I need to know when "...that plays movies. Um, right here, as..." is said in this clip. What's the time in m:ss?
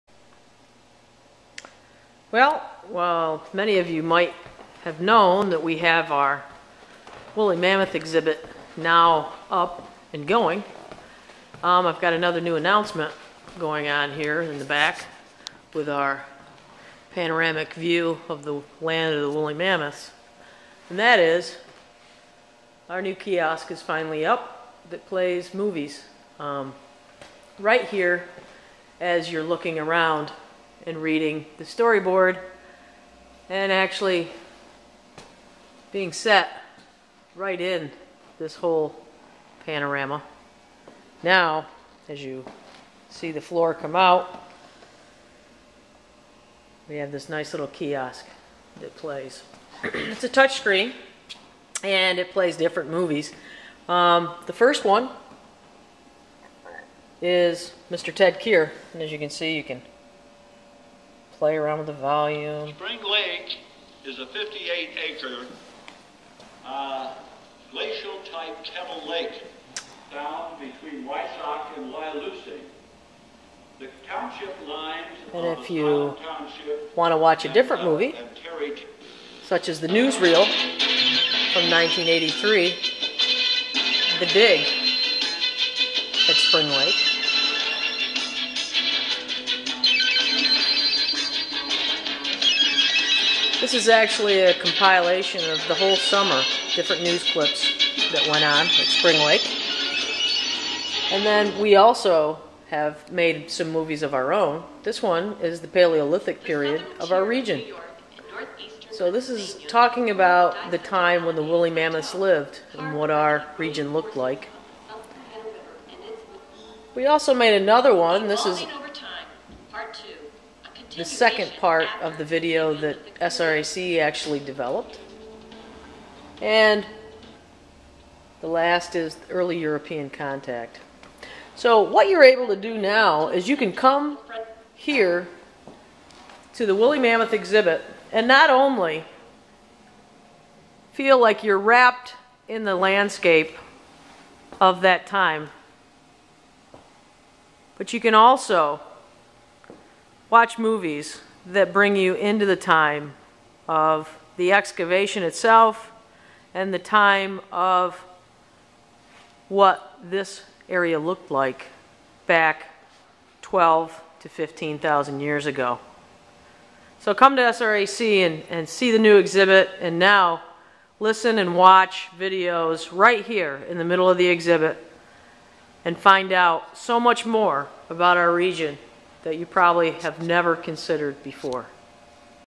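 0:24.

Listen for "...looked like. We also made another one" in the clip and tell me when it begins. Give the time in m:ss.
1:53.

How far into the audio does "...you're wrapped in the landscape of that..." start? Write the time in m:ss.
2:21.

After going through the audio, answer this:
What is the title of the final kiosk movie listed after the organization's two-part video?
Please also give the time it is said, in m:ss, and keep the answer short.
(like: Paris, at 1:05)
Early European contact, at 2:09.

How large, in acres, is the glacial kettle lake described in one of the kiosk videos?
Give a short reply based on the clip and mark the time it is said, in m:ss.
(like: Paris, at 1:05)
58 acres, at 1:04.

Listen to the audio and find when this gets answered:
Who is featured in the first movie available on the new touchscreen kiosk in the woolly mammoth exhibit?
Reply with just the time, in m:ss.
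0:57.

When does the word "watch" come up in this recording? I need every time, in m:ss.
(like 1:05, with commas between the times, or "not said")
1:17, 2:30, 2:51.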